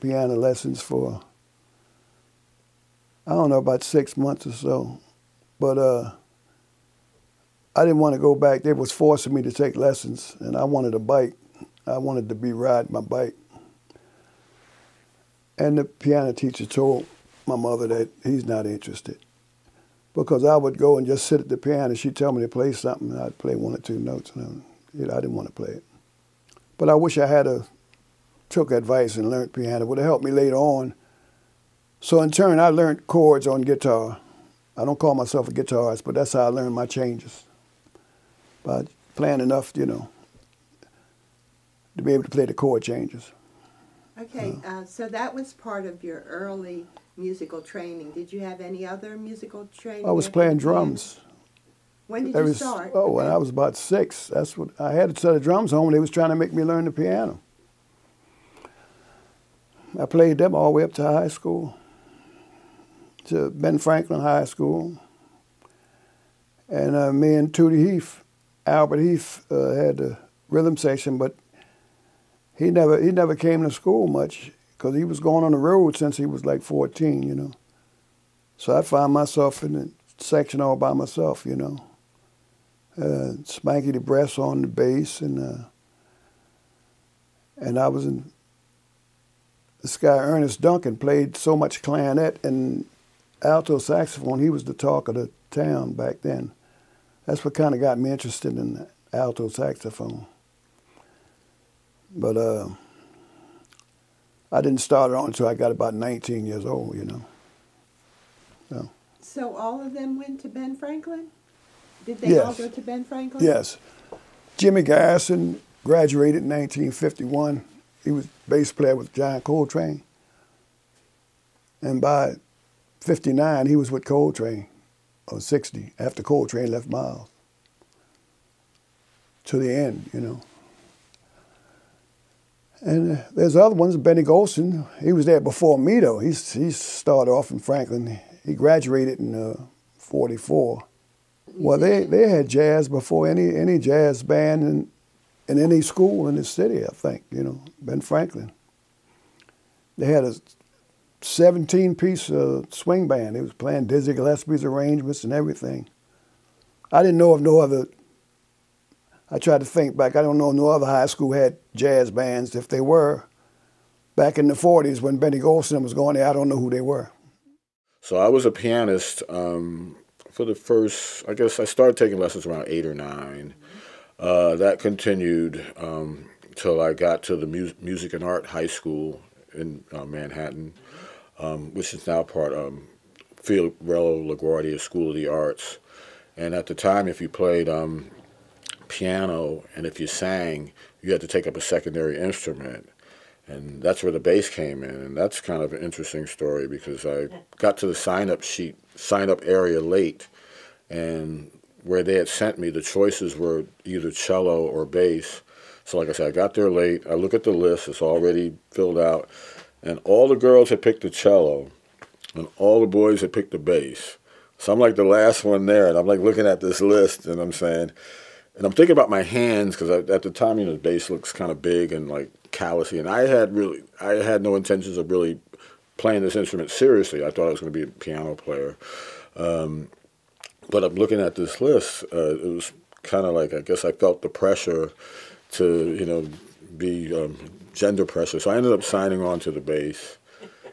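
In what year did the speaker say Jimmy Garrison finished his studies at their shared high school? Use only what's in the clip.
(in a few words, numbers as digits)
1951.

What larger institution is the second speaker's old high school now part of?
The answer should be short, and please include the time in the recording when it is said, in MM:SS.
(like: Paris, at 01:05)
Fiorello LaGuardia School of the Arts, at 03:03.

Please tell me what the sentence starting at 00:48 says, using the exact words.
Did you have any other musical training?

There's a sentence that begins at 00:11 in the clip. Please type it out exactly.
I wanted to be riding my bike.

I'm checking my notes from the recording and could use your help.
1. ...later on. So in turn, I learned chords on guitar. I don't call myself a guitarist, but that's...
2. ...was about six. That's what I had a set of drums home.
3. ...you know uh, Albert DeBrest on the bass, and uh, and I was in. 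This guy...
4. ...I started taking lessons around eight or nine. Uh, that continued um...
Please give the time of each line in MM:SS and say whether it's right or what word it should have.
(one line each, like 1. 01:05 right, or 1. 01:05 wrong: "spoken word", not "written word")
1. 00:30 right
2. 00:53 right
3. 01:21 wrong: "Spanky", not "Albert"
4. 02:51 right.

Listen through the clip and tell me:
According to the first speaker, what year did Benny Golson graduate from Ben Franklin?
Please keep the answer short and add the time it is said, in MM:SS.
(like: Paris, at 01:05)
1944, at 02:19.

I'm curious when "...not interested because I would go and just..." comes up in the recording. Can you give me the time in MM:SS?
00:18.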